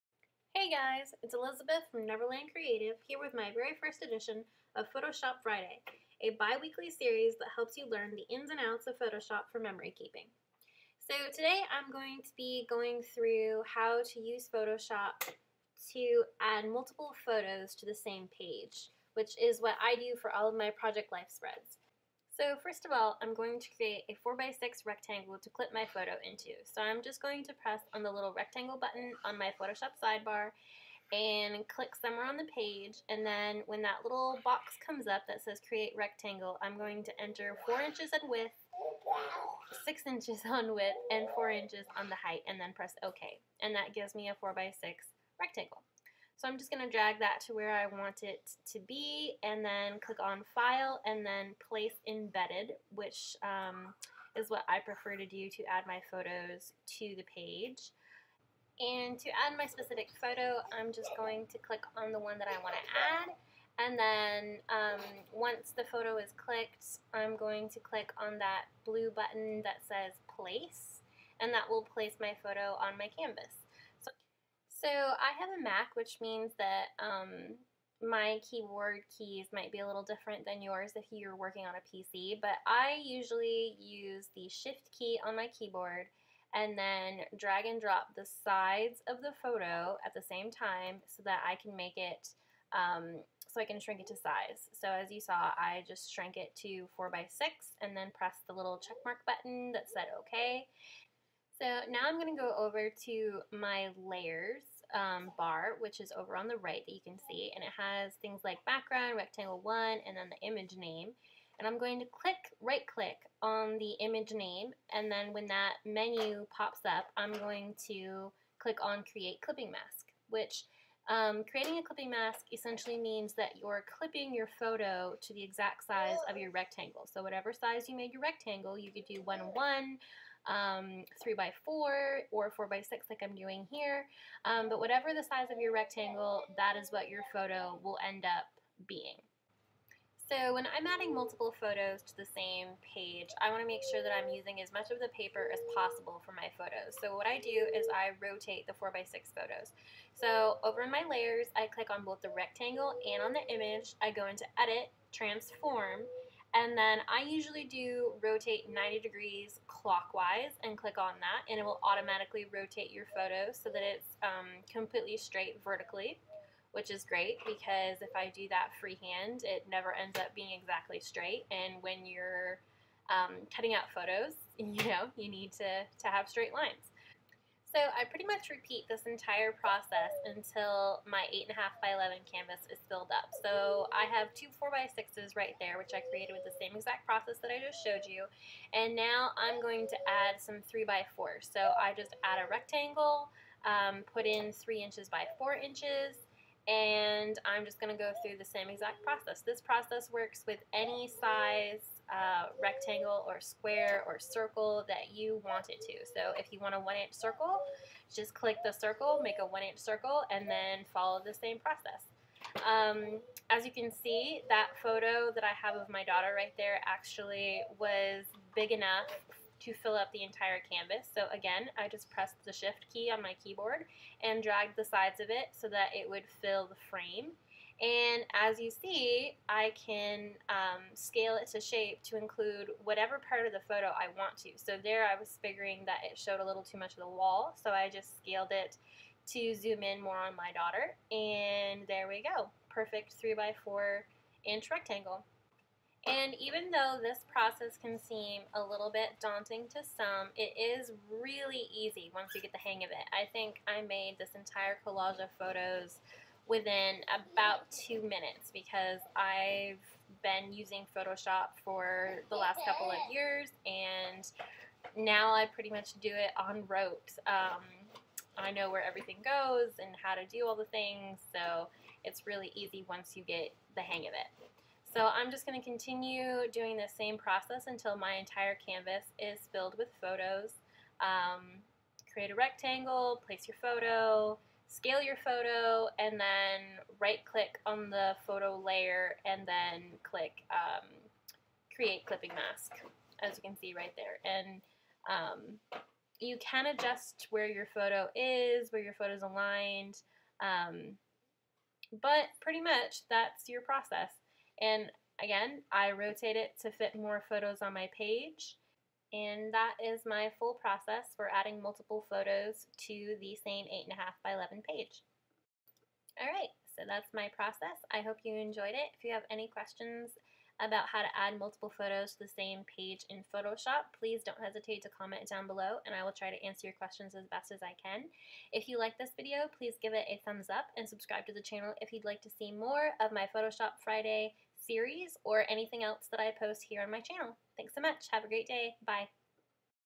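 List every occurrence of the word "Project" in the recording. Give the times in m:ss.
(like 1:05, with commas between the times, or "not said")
0:20.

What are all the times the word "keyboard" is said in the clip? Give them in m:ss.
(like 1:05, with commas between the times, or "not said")
1:18, 1:25, 3:43.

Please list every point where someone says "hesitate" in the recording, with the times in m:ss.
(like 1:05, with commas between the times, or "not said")
5:24.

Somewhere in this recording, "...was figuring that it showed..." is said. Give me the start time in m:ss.
3:55.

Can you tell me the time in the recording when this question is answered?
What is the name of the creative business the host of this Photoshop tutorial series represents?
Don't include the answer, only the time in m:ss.
0:02.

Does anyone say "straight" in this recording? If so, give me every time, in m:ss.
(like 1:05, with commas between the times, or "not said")
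2:45, 2:50, 2:56.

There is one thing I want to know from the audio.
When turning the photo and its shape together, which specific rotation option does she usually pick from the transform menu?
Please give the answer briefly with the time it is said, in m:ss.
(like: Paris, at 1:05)
Rotate 90 degrees clockwise, at 2:38.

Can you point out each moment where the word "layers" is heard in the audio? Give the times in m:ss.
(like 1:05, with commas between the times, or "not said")
1:43, 2:31, 4:48.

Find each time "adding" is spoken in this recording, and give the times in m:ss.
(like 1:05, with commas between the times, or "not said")
2:20, 5:11.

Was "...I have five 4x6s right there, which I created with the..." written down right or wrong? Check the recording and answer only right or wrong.
wrong.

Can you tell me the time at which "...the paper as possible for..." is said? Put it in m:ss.
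2:25.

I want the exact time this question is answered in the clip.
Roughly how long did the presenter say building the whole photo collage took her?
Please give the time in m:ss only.
4:17.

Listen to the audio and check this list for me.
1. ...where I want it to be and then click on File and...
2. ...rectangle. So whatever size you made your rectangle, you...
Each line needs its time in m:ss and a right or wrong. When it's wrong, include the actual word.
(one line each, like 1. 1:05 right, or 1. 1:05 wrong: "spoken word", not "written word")
1. 0:47 right
2. 2:06 right.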